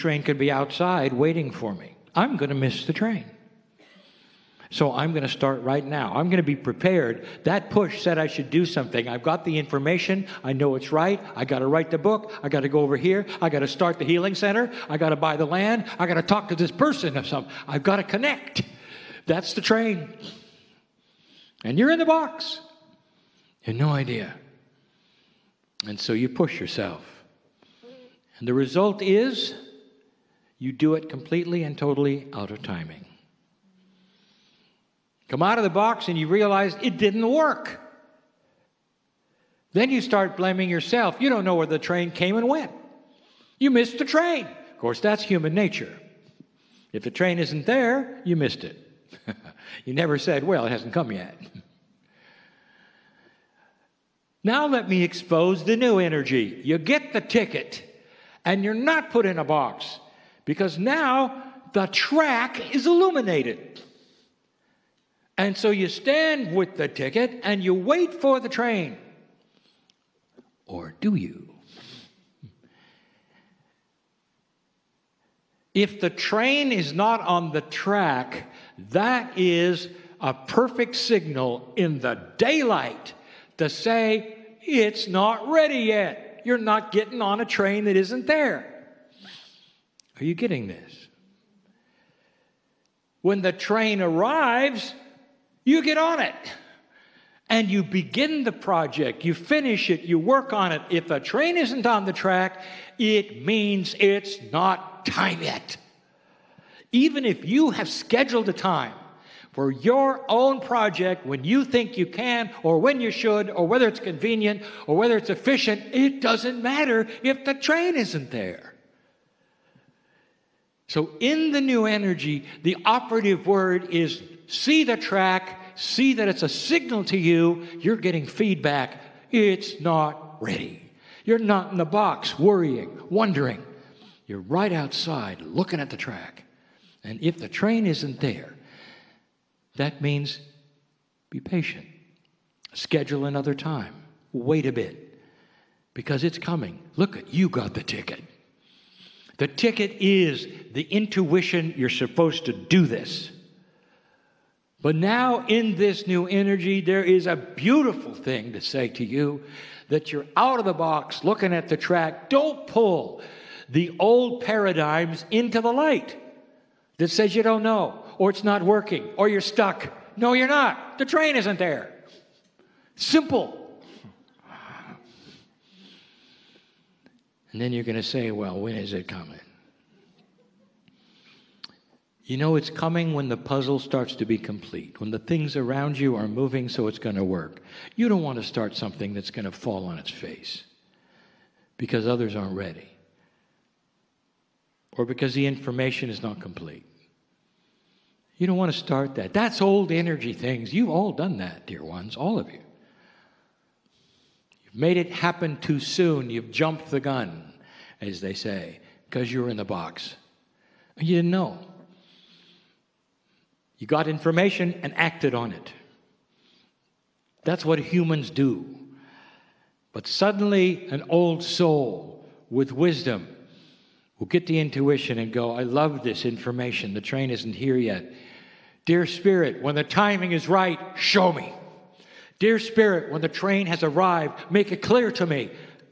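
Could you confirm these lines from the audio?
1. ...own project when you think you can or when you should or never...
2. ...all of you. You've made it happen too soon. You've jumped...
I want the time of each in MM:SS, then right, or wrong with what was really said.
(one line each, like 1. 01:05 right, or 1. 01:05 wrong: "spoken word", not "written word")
1. 01:50 wrong: "whether", not "never"
2. 03:22 right.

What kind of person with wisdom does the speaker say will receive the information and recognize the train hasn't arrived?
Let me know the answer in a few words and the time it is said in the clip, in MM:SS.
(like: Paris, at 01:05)
An old soul, at 03:40.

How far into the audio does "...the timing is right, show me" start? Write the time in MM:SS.
03:49.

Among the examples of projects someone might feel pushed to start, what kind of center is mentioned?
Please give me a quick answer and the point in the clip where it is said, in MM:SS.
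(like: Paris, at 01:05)
Healing center, at 00:14.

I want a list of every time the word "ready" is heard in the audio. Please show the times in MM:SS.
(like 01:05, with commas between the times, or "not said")
01:25, 02:10, 03:12.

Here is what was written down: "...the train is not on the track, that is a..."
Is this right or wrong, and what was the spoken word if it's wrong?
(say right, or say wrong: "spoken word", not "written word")
right.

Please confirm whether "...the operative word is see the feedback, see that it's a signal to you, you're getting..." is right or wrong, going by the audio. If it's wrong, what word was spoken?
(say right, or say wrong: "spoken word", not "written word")
wrong: "track", not "feedback".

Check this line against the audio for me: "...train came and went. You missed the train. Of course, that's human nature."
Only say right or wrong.
right.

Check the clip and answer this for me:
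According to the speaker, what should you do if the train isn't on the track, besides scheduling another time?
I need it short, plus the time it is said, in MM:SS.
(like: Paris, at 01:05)
Be patient, at 02:21.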